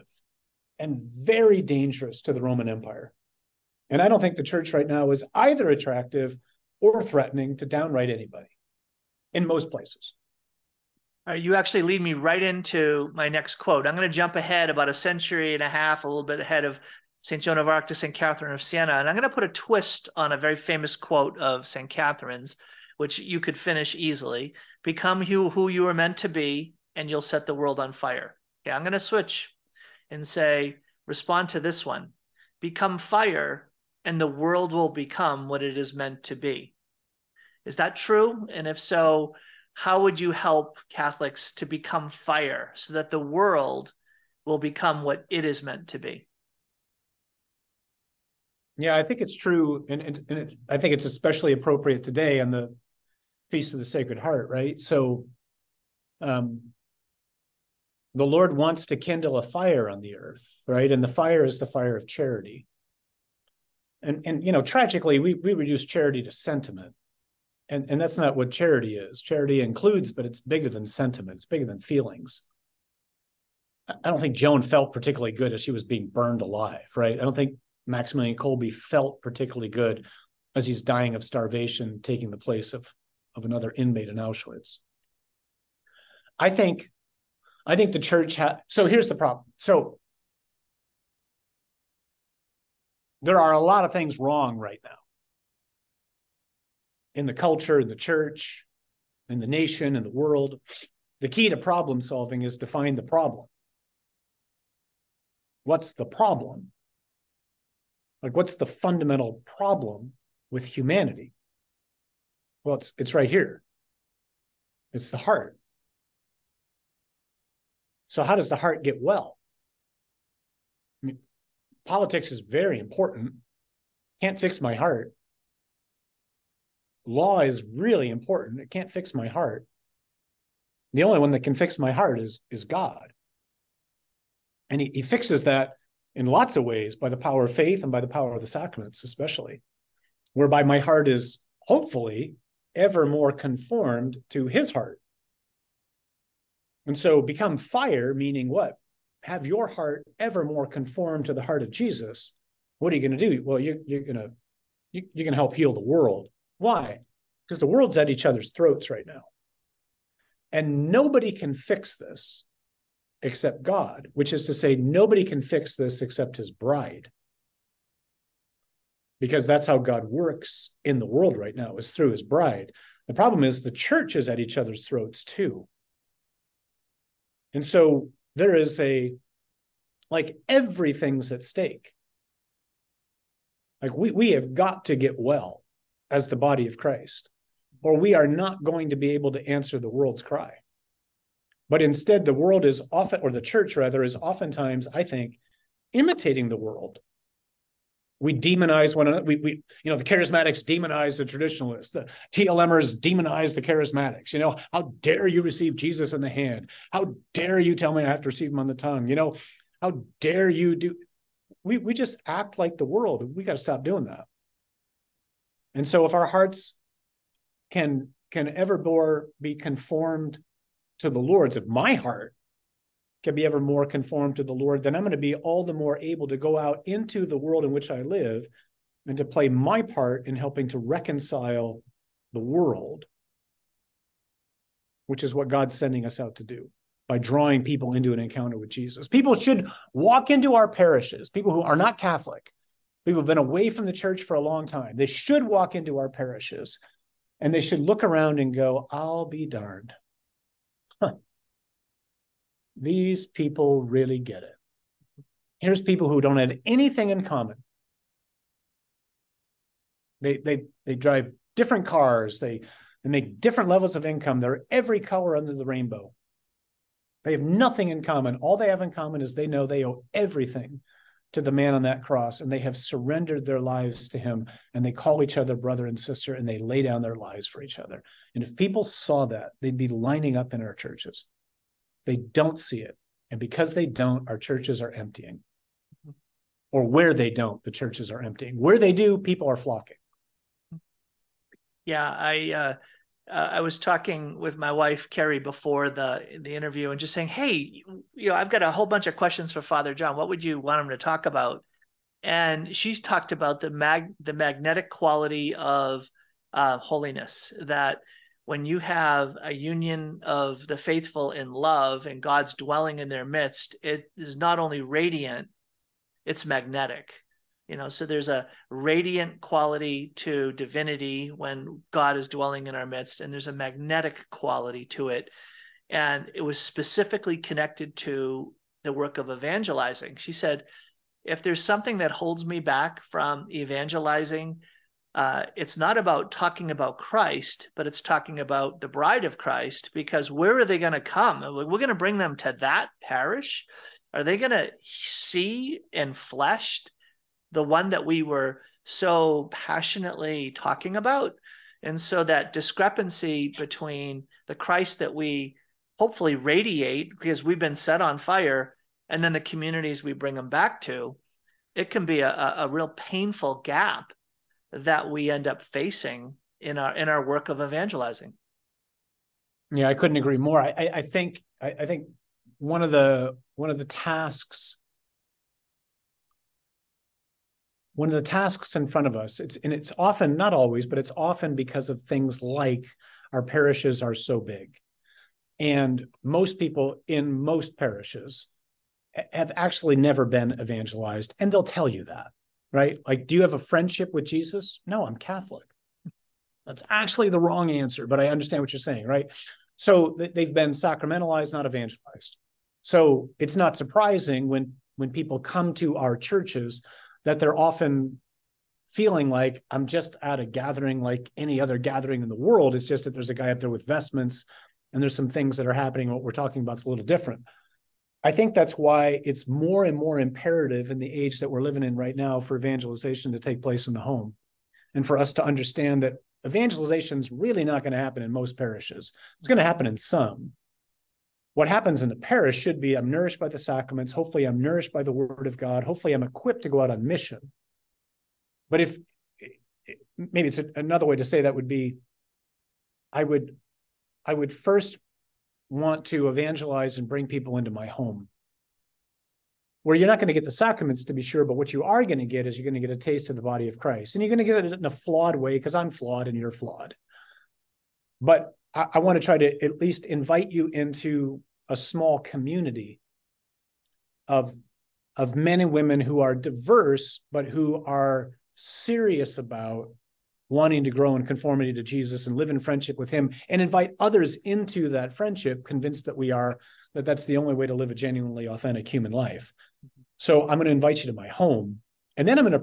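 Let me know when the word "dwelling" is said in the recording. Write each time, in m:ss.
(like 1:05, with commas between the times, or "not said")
5:12, 5:22.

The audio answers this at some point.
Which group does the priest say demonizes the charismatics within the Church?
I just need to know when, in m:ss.
3:22.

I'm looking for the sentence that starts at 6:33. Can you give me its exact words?
Like, do you have a friendship with Jesus?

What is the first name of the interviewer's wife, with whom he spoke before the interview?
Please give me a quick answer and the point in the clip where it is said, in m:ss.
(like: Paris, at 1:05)
Carrie, at 4:55.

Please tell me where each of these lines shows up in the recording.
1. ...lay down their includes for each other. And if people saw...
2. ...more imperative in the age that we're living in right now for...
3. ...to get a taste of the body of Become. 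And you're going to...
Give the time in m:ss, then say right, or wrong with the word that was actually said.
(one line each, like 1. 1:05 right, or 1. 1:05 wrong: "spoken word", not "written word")
1. 4:36 wrong: "lives", not "includes"
2. 6:59 right
3. 7:32 wrong: "Christ", not "Become".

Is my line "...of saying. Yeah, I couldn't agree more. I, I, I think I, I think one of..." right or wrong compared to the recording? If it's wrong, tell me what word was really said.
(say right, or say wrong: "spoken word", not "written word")
wrong: "evangelizing", not "saying".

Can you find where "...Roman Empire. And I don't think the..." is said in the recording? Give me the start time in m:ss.
0:02.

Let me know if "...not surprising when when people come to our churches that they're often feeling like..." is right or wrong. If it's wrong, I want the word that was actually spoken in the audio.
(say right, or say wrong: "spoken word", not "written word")
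right.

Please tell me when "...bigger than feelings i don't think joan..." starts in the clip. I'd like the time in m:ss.
1:11.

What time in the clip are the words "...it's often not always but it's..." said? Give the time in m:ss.
6:19.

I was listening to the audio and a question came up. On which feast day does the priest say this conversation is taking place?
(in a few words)
Feast of the Sacred Heart.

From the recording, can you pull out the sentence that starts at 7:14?
Hopefully, I'm nourished by the word of God.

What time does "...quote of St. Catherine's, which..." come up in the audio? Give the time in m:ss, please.
0:20.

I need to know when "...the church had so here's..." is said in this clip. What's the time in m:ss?
1:27.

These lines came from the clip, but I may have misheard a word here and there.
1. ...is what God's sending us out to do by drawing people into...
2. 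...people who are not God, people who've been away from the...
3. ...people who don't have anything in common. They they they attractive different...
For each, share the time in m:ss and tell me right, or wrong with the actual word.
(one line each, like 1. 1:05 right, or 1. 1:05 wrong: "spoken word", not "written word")
1. 3:55 right
2. 4:01 wrong: "Catholic", not "God"
3. 4:15 wrong: "drive", not "attractive".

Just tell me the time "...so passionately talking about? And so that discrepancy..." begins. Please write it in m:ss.
5:48.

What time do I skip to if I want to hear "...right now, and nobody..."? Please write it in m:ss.
2:38.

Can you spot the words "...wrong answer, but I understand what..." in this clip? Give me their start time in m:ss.
6:37.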